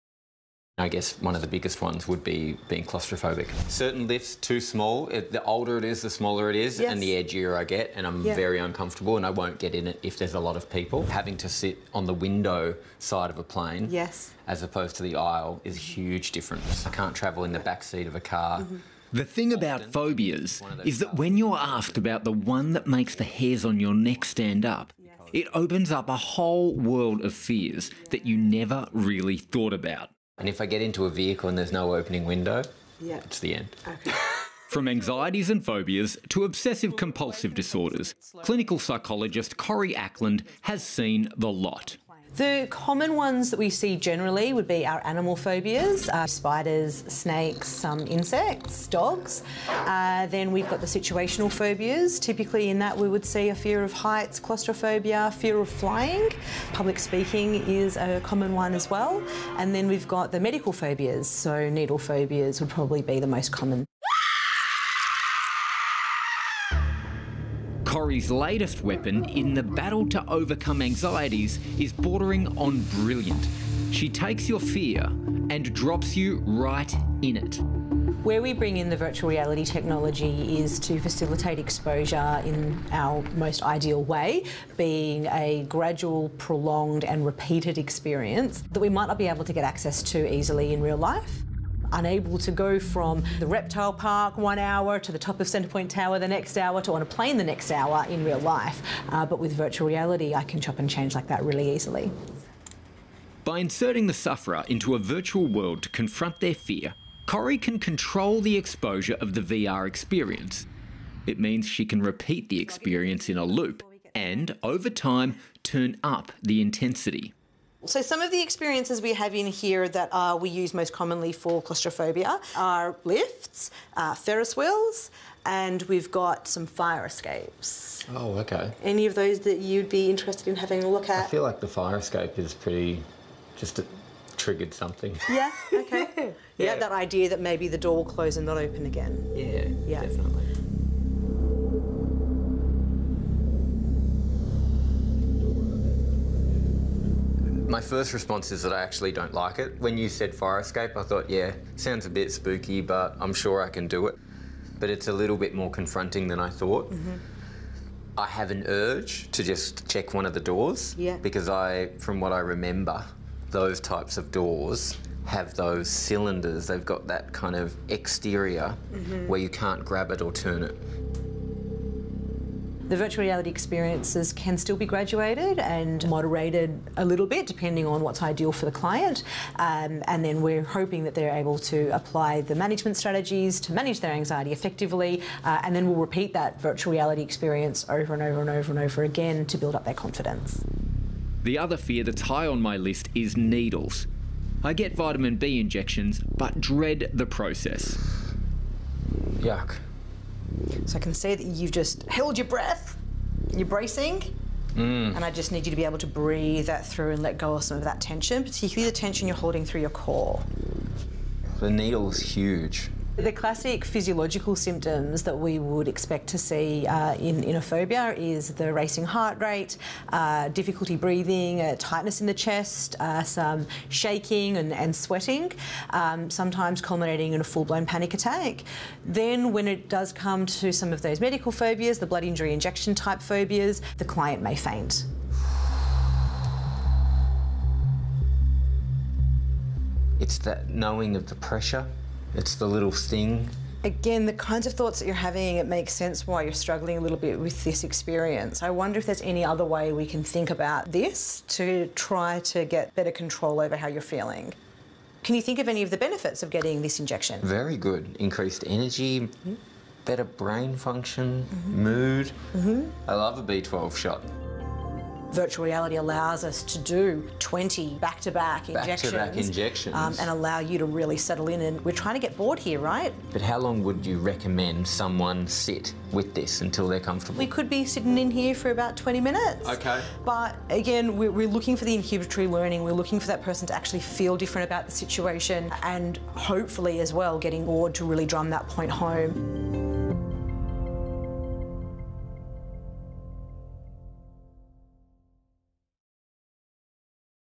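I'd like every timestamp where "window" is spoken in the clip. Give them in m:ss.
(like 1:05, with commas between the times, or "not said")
0:12, 0:32.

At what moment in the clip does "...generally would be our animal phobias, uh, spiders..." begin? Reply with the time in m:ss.
0:43.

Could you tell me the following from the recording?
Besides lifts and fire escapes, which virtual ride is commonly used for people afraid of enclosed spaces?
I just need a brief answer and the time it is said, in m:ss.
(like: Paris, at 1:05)
Ferris wheels, at 2:04.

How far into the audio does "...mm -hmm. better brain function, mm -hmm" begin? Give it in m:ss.
4:19.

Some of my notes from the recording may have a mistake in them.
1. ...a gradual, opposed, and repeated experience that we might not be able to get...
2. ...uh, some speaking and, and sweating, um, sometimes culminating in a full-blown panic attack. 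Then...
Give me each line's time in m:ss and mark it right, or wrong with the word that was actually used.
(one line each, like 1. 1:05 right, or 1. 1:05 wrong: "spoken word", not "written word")
1. 1:25 wrong: "prolonged", not "opposed"
2. 3:42 wrong: "shaking", not "speaking".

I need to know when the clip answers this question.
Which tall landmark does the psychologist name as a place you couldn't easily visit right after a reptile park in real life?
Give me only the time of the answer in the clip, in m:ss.
1:35.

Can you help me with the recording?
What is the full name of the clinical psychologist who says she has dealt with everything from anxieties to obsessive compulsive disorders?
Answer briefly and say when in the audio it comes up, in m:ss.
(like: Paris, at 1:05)
Corey Ackland, at 0:39.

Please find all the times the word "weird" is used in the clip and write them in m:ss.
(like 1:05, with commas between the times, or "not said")
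not said.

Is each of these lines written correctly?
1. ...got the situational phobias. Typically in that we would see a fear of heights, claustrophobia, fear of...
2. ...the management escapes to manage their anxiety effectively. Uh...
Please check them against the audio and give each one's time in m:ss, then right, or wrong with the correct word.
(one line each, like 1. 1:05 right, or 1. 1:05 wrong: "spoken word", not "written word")
1. 0:50 right
2. 3:02 wrong: "strategies", not "escapes".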